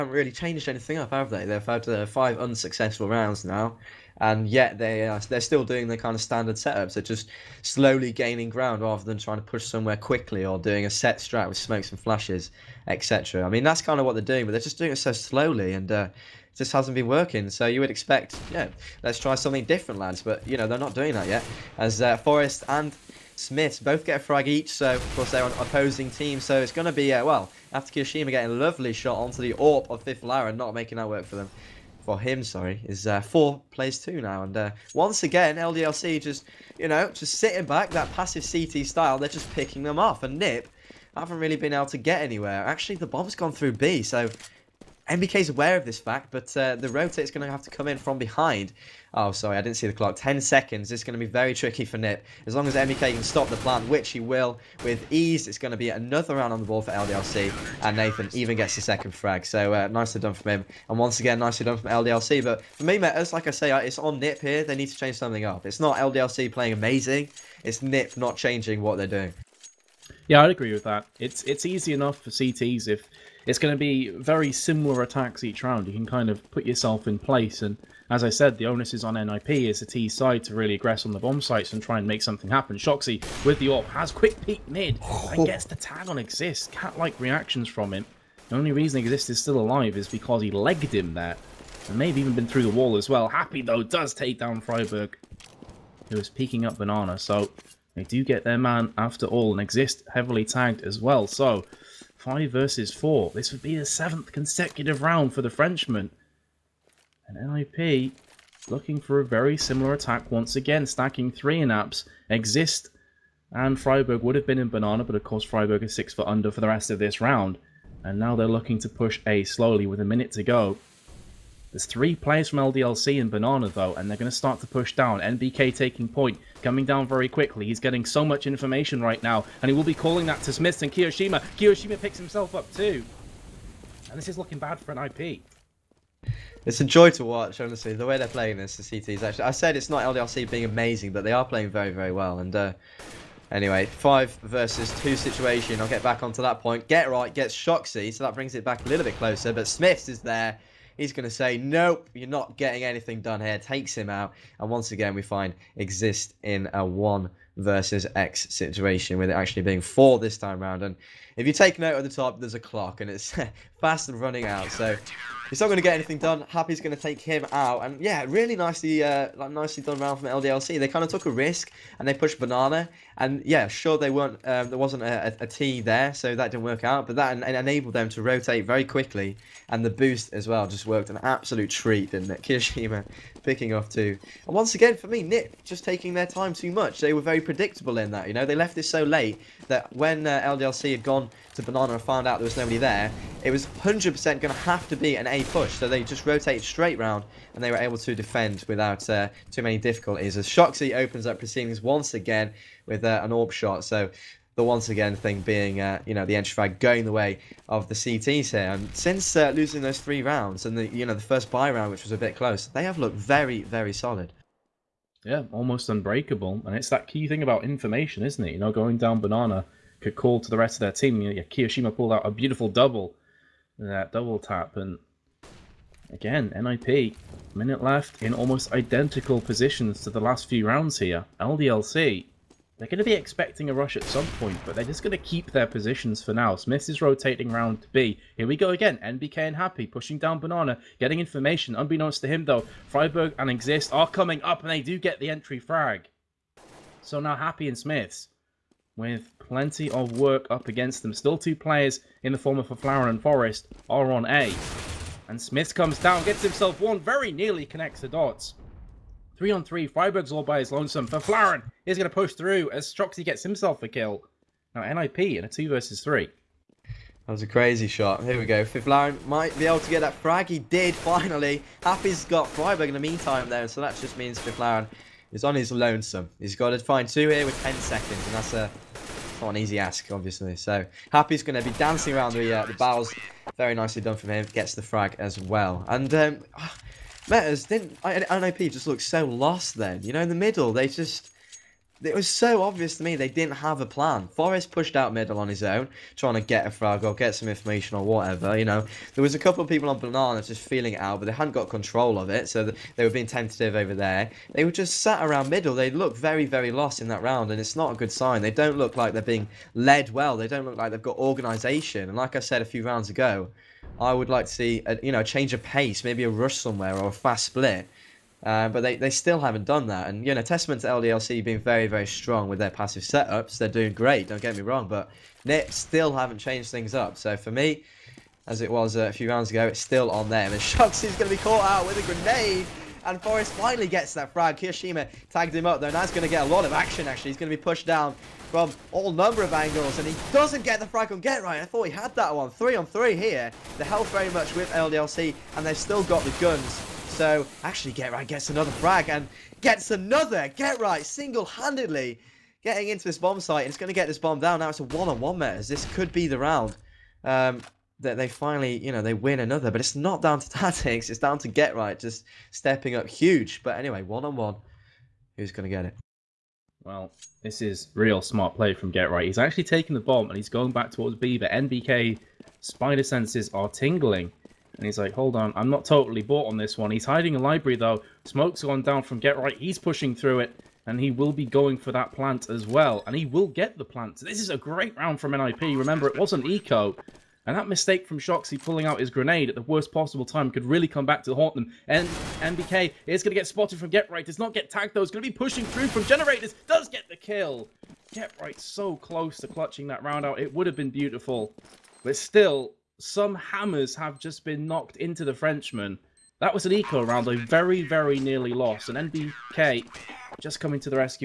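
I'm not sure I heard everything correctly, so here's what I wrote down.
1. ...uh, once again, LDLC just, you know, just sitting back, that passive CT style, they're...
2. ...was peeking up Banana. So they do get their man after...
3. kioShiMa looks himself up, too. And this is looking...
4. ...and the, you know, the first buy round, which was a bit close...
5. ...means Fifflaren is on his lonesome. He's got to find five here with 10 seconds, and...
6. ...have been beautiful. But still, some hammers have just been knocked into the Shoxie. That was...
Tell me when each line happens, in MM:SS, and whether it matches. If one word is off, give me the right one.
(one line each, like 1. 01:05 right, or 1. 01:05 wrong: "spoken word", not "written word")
1. 00:34 right
2. 01:36 right
3. 02:11 wrong: "picks", not "looks"
4. 03:30 right
5. 04:34 wrong: "two", not "five"
6. 06:40 wrong: "Frenchman", not "Shoxie".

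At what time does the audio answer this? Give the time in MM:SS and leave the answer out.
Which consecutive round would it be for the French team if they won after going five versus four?
01:43.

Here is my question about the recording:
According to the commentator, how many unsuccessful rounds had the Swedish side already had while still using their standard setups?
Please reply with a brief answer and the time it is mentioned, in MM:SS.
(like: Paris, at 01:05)
5, at 00:02.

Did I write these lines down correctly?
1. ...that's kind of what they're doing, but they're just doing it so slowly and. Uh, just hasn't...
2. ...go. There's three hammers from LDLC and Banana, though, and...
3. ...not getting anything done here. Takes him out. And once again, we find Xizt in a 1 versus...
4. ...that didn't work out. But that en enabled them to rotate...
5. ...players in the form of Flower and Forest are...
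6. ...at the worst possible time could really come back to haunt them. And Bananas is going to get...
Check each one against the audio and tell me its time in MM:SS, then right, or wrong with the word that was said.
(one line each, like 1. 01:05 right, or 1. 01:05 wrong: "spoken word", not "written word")
1. 00:13 right
2. 02:00 wrong: "players", not "hammers"
3. 02:32 right
4. 02:56 right
5. 04:11 right
6. 06:29 wrong: "NBK", not "Bananas".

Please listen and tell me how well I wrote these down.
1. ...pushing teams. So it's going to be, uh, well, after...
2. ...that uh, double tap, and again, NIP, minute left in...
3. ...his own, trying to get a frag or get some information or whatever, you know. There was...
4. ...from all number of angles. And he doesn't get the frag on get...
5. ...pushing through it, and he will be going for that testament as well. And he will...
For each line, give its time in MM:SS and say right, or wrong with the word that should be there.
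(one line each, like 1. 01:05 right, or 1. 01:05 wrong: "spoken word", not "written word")
1. 00:25 wrong: "opposing", not "pushing"
2. 03:43 right
3. 04:55 right
4. 05:38 right
5. 06:19 wrong: "plant", not "testament".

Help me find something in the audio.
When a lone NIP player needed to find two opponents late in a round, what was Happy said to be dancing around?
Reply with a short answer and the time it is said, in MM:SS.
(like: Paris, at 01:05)
The barrels, at 04:42.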